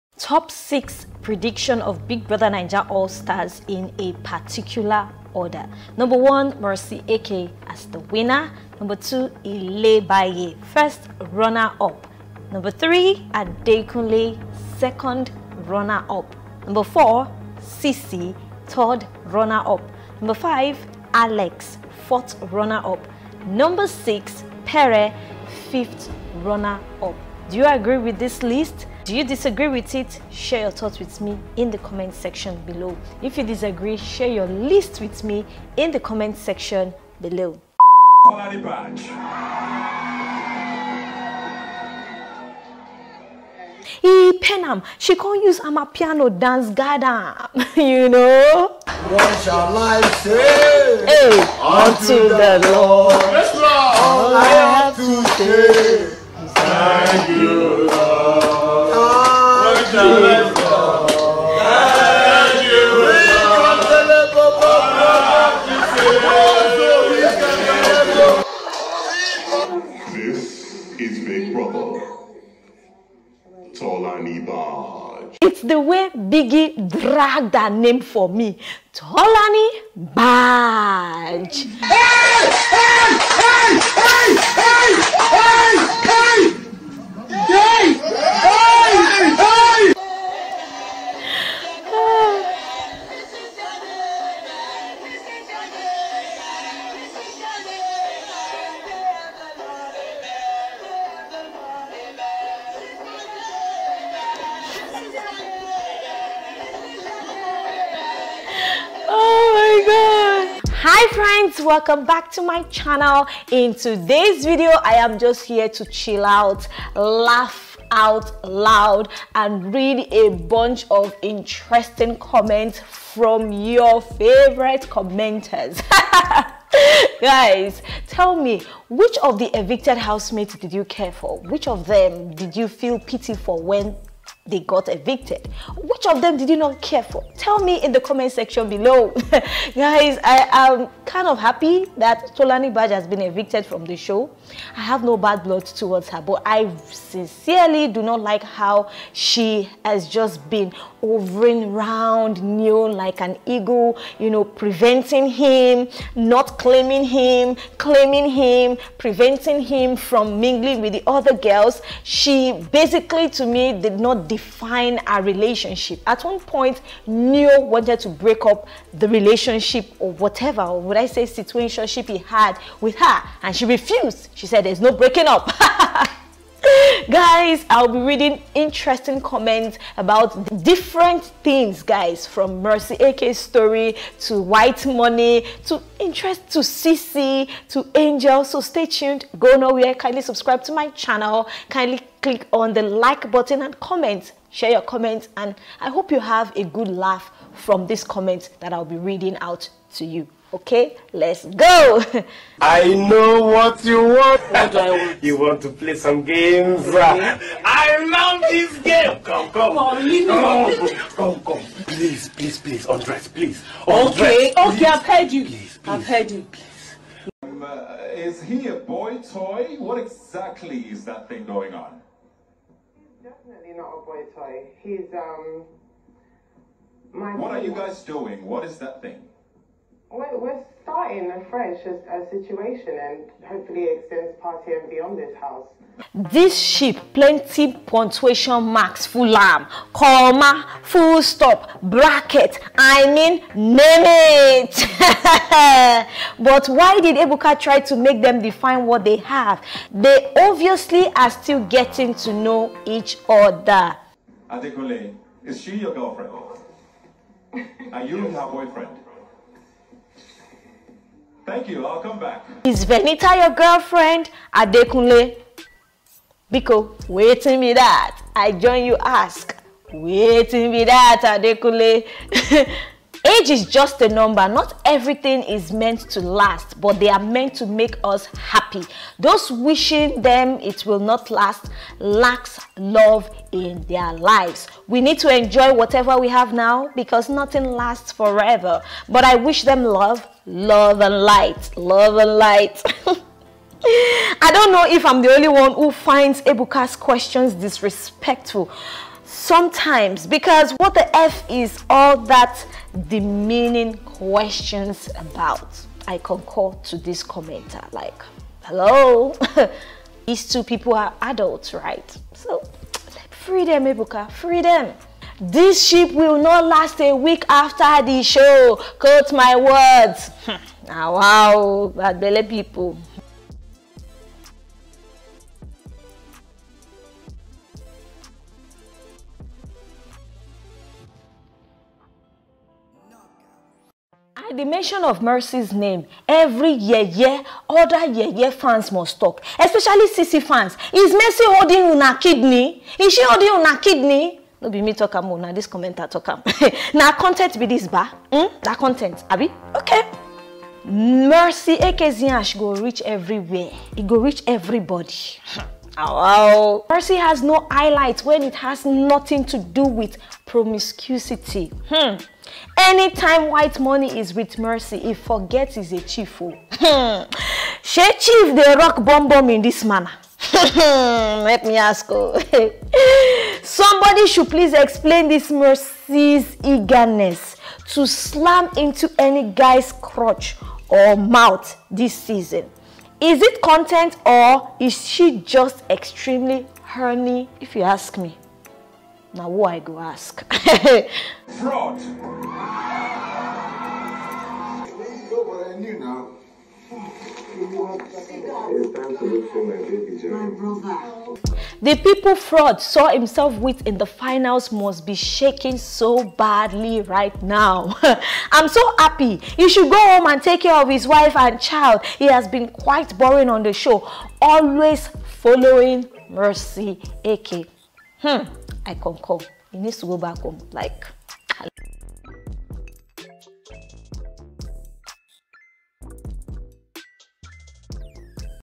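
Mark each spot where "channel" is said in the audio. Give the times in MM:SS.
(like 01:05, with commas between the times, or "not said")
01:52, 03:10.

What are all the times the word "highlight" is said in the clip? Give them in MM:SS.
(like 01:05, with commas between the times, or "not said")
05:57.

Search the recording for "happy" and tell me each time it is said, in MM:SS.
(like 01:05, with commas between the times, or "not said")
02:21, 04:38, 06:48.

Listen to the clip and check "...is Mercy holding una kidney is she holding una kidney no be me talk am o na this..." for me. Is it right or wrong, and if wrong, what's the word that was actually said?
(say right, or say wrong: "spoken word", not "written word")
right.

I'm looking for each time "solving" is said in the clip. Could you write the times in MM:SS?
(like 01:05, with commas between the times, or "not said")
not said.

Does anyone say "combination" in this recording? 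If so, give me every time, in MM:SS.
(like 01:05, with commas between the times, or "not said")
not said.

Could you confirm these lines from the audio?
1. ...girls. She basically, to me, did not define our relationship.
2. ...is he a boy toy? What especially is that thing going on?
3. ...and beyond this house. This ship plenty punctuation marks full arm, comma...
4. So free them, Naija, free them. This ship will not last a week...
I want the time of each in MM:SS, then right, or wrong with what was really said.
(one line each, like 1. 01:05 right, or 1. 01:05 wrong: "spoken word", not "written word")
1. 02:41 right
2. 03:38 wrong: "exactly", not "especially"
3. 03:54 right
4. 05:12 wrong: "Ebuka", not "Naija".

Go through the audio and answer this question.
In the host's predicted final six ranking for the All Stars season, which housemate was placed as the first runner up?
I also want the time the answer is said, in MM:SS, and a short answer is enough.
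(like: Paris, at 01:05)
Ilebaye, at 00:09.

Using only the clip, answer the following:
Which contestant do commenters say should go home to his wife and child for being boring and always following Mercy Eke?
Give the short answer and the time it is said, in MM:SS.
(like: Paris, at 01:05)
Frodd, at 06:42.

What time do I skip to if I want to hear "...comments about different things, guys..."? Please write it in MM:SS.
02:59.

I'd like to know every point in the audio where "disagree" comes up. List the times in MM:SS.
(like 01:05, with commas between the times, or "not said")
00:29, 00:33.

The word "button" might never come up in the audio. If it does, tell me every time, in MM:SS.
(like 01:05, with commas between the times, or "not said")
03:13.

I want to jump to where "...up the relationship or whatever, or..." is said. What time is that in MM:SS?
02:48.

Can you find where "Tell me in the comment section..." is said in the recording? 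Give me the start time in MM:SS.
02:17.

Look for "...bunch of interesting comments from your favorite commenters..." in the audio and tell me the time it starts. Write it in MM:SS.
02:00.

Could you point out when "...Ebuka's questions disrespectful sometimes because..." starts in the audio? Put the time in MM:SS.
04:56.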